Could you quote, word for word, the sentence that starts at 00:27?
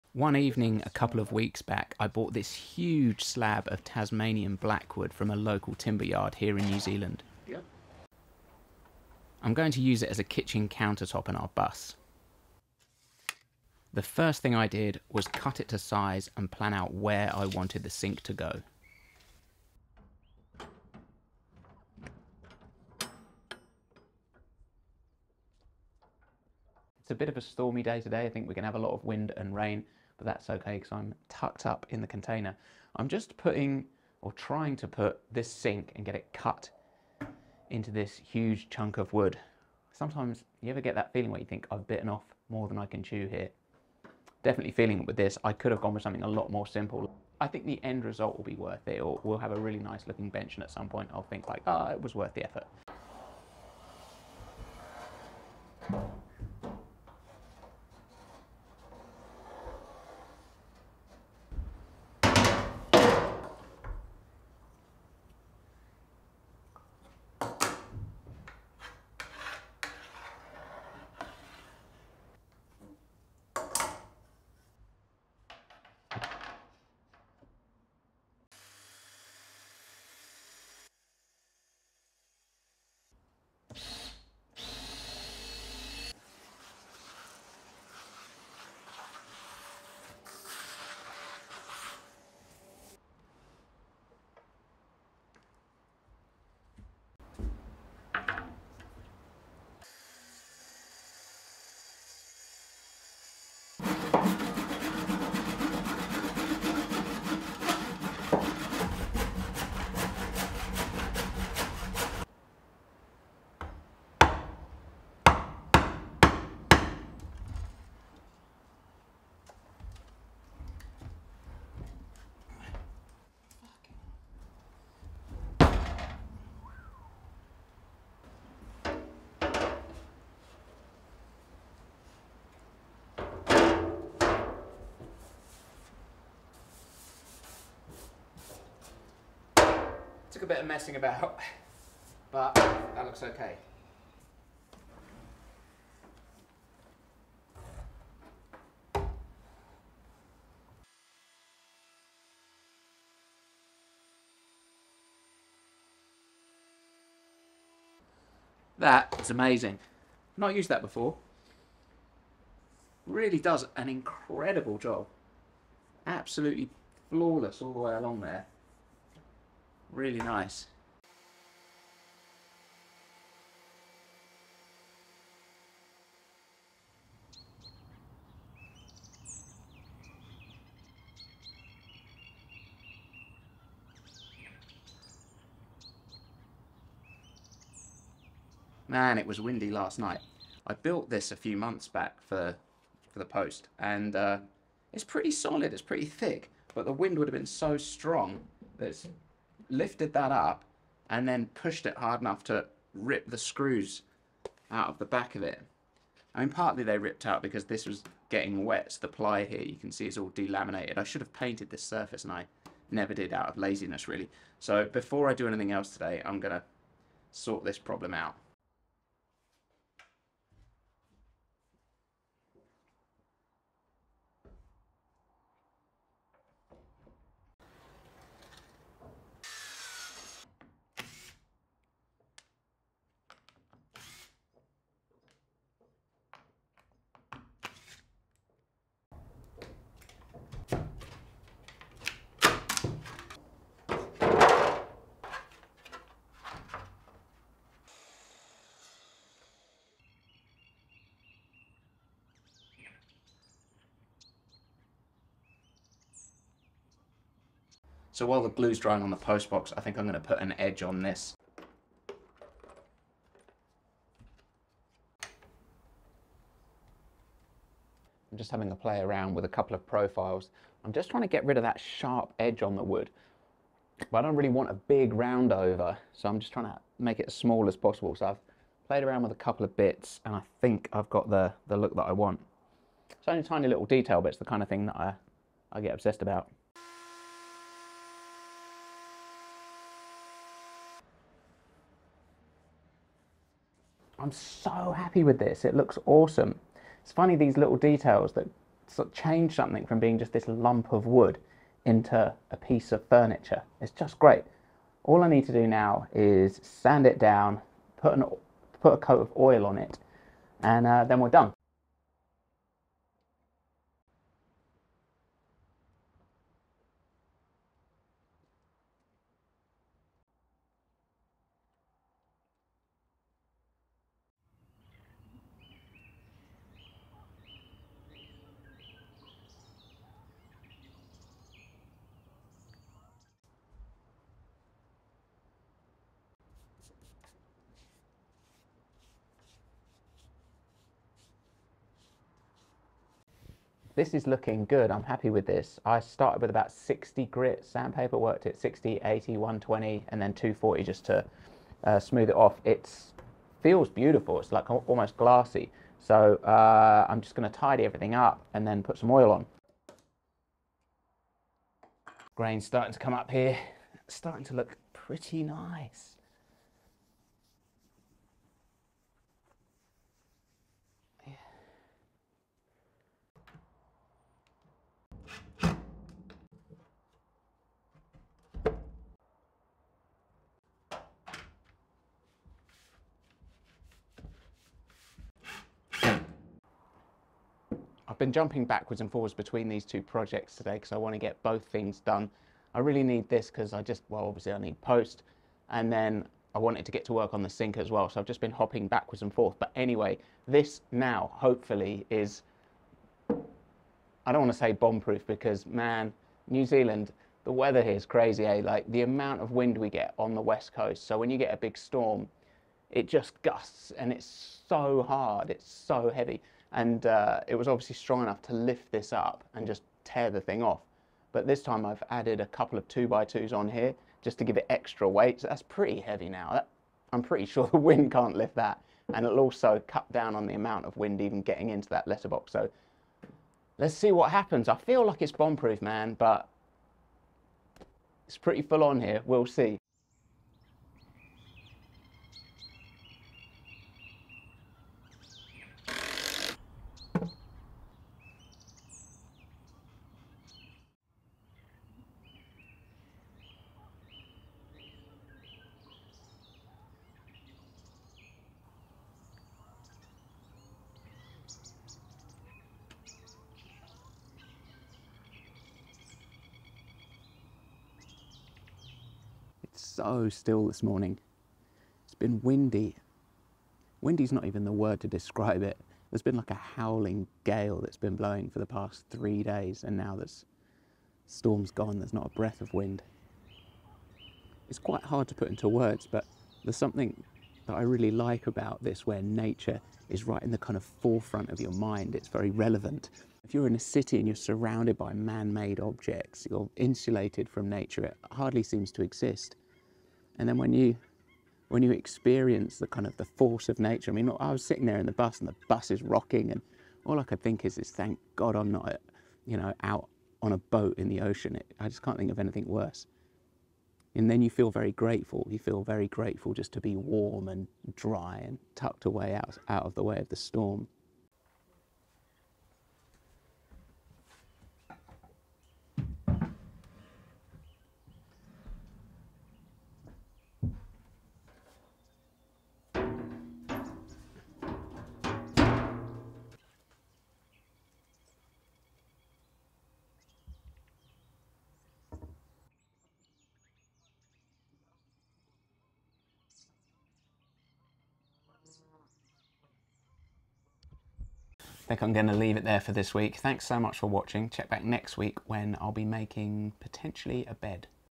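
It's a bit of a stormy day today.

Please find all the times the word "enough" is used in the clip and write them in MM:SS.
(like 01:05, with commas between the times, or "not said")
03:22, 06:58.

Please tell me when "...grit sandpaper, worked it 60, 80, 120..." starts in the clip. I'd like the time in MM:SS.
05:47.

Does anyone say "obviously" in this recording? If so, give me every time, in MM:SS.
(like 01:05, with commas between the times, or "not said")
06:34, 06:57.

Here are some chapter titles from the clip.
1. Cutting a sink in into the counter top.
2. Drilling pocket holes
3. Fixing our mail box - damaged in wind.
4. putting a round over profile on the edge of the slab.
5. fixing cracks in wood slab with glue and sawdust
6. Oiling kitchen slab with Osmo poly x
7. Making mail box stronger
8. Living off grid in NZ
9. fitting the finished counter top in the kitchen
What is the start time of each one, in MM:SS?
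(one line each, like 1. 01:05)
1. 00:22
2. 02:29
3. 03:00
4. 04:18
5. 05:18
6. 06:00
7. 06:15
8. 07:34
9. 08:42.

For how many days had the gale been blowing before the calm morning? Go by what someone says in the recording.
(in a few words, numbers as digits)
3.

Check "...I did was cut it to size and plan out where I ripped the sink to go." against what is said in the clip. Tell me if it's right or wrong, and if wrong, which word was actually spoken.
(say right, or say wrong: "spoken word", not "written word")
wrong: "wanted", not "ripped".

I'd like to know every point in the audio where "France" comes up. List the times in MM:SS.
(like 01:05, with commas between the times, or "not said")
not said.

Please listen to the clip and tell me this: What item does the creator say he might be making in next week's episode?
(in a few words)
A bed.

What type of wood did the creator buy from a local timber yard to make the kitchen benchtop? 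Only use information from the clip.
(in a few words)
Tasmanian blackwood.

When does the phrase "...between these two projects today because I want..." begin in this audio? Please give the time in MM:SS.
06:29.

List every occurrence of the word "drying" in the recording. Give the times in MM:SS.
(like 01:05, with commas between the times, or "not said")
04:18.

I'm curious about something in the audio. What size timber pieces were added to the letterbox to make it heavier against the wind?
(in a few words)
2x2s.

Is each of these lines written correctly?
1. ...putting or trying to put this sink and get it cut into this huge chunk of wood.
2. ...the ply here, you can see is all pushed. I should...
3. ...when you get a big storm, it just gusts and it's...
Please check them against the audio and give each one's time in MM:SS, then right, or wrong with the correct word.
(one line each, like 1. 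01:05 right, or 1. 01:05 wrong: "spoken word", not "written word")
1. 00:33 right
2. 03:29 wrong: "delaminated", not "pushed"
3. 06:51 right.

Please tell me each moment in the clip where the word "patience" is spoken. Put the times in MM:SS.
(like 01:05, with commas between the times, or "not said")
not said.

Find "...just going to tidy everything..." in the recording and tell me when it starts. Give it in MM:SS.
05:57.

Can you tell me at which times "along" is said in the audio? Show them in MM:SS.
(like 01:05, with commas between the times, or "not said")
02:47.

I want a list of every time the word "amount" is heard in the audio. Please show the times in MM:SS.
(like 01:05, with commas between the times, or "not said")
06:49, 07:10.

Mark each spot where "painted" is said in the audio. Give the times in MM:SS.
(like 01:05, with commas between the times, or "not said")
03:31.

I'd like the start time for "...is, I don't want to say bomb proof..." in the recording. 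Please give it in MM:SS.
06:42.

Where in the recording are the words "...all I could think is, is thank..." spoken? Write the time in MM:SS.
08:27.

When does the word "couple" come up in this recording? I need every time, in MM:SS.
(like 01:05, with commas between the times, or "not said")
00:00, 04:29, 04:39, 07:02.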